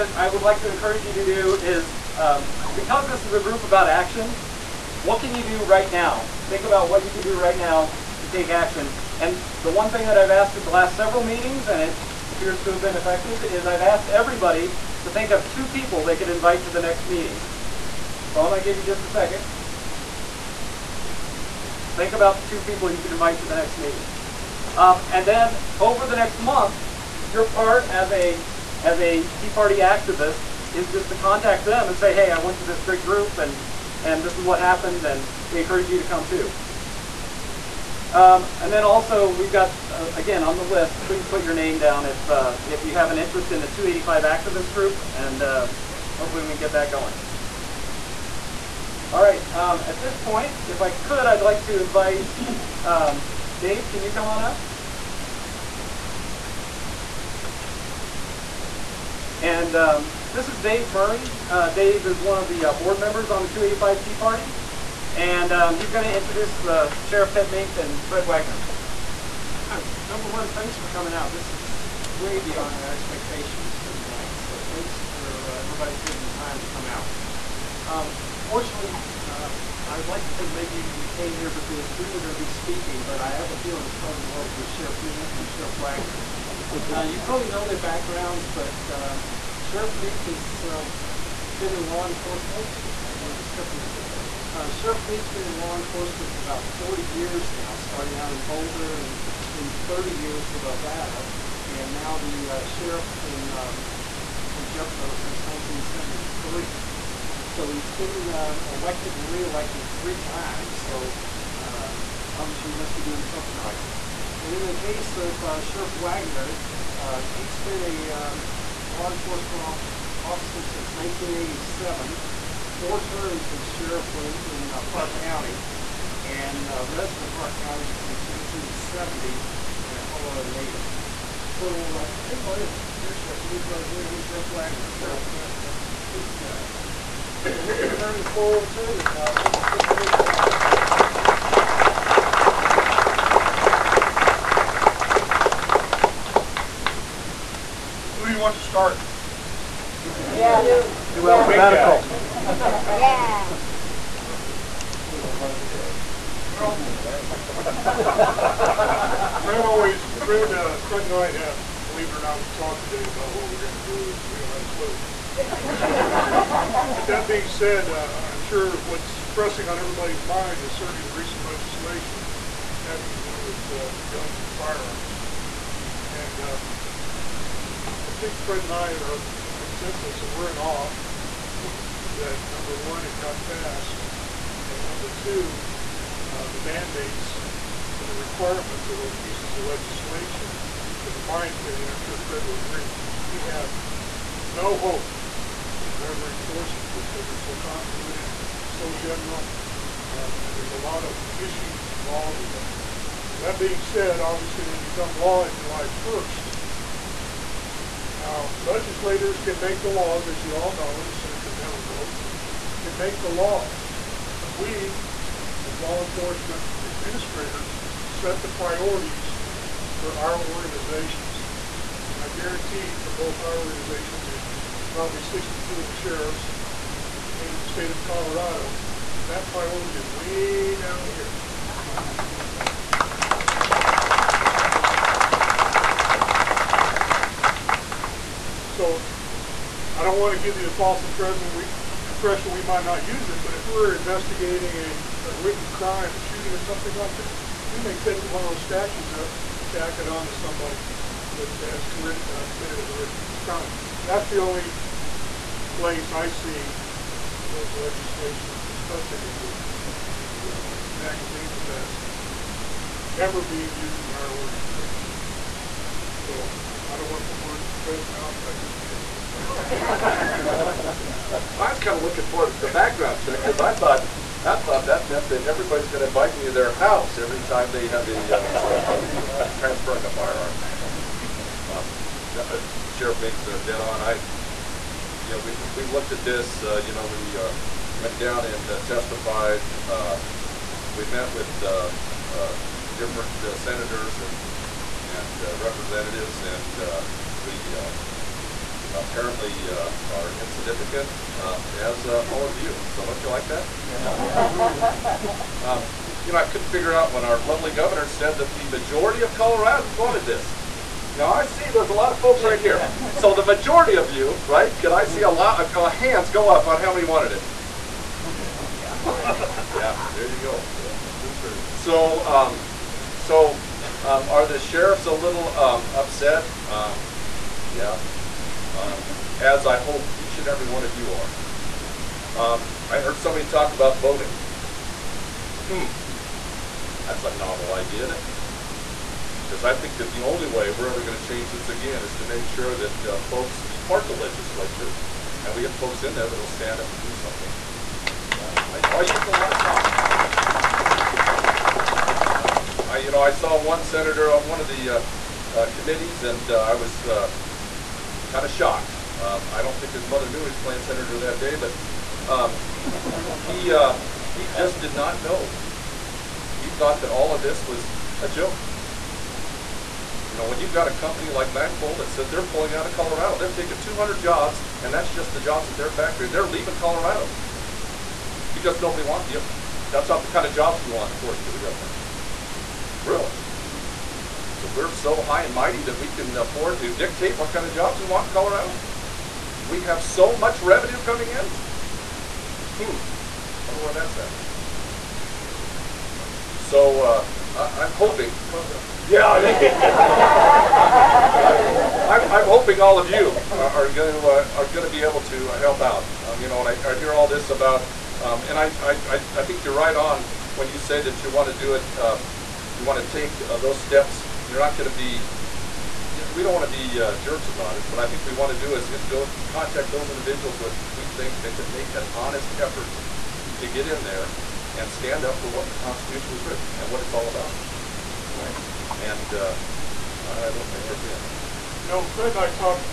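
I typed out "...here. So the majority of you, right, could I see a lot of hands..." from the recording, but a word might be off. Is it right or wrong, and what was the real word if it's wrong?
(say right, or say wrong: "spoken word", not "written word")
right.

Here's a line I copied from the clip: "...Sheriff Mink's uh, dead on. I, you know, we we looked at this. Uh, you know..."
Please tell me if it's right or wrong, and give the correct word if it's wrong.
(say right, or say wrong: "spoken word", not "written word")
right.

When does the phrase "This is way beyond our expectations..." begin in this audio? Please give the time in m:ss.
1:11.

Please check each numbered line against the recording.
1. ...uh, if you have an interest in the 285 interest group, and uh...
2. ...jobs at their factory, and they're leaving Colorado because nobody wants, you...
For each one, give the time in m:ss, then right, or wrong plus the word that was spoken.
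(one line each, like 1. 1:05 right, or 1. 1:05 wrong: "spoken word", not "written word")
1. 0:42 wrong: "activist", not "interest"
2. 6:15 right.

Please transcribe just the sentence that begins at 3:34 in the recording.
But we, as law enforcement administrators, set the priorities for our organizations.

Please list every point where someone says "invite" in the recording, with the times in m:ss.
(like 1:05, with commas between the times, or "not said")
0:16, 0:23, 0:51, 4:36.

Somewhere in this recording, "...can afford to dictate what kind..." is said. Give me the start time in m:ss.
6:26.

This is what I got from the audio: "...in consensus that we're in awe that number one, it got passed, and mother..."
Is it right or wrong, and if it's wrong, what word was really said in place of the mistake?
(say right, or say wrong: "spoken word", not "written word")
wrong: "number", not "mother".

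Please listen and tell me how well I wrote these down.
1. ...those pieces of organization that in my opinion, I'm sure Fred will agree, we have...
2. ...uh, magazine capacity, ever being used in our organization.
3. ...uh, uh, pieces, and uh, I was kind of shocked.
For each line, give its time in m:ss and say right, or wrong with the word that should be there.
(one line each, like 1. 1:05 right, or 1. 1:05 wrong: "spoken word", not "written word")
1. 3:08 wrong: "legislation", not "organization"
2. 4:20 right
3. 5:54 wrong: "committees", not "pieces".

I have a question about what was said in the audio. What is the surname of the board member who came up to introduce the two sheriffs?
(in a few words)
Murray.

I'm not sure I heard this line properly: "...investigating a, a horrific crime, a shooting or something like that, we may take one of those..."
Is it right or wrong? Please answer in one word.
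right.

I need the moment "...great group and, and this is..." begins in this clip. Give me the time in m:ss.
0:32.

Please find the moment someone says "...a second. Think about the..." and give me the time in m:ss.
0:19.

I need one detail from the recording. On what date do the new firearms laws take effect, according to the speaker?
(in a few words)
July 1st.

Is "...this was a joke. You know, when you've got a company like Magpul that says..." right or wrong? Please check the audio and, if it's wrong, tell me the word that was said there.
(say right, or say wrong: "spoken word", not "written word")
right.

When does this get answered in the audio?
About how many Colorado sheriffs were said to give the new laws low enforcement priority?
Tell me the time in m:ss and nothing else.
3:45.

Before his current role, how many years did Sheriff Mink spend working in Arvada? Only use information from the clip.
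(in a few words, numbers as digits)
30.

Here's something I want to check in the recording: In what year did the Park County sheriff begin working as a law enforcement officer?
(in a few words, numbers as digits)
1987.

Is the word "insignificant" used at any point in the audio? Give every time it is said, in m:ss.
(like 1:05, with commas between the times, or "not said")
5:00.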